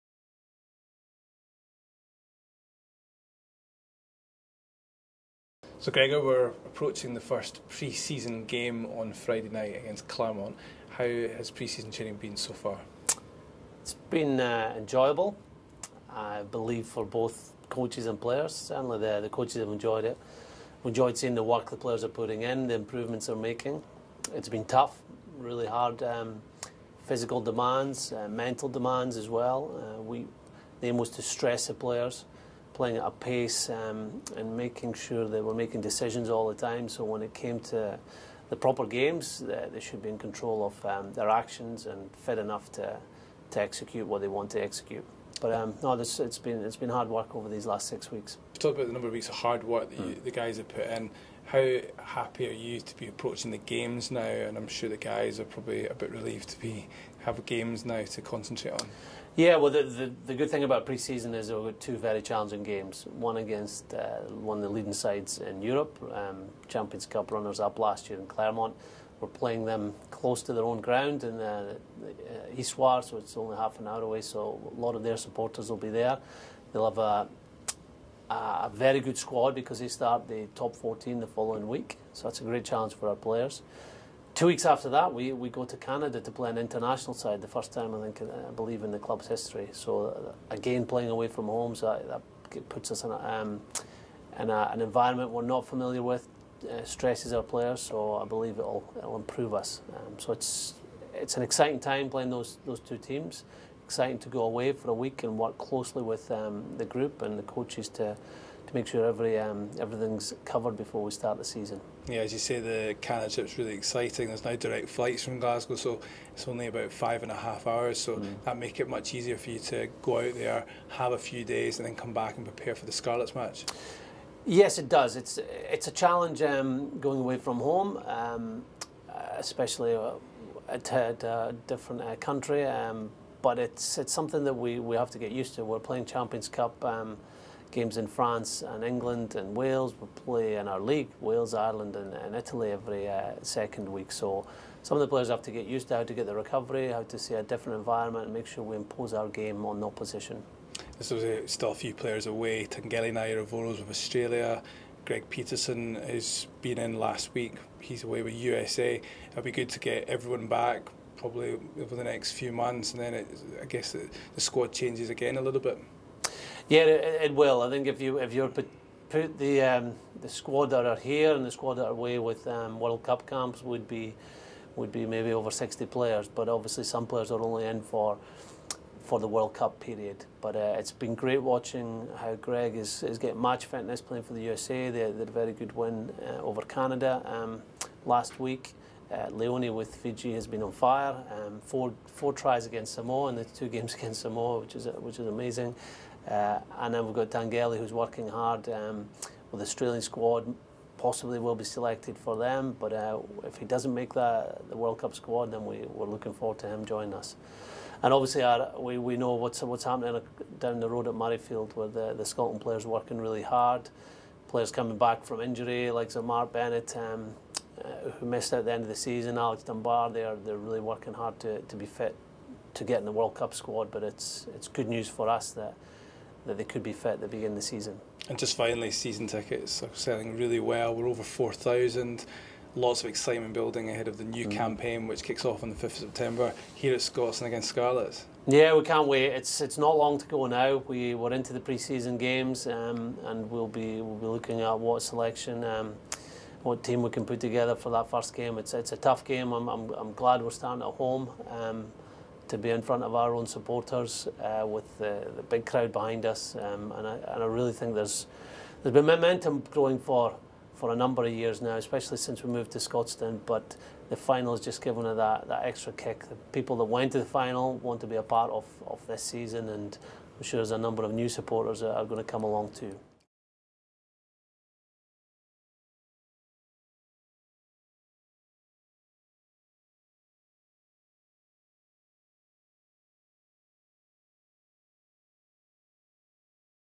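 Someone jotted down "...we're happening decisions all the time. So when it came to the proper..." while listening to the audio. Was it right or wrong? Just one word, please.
wrong.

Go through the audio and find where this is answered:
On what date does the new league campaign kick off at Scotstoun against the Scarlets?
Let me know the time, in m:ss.
3:55.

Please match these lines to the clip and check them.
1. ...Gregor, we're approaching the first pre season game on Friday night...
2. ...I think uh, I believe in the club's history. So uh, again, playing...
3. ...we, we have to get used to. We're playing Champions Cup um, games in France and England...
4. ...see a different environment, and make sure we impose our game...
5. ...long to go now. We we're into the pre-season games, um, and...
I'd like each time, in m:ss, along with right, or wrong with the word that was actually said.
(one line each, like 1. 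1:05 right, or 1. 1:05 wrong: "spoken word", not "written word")
1. 0:05 right
2. 1:27 right
3. 2:14 right
4. 2:27 right
5. 3:59 right.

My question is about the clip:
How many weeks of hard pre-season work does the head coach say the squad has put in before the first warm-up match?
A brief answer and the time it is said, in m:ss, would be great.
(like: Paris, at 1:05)
6, at 0:47.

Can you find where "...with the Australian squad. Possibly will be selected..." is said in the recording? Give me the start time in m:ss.
3:19.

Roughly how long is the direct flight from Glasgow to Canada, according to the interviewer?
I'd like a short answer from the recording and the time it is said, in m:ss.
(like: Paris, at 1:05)
5 and a half hours, at 1:56.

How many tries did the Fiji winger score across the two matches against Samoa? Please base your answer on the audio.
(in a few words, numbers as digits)
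4.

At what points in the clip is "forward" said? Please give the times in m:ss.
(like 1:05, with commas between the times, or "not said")
3:26.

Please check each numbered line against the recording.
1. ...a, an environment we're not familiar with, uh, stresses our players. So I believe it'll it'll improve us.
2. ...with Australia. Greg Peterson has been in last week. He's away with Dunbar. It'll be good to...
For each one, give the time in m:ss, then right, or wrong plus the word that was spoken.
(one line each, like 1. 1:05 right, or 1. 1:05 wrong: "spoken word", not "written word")
1. 1:34 right
2. 2:33 wrong: "USA", not "Dunbar".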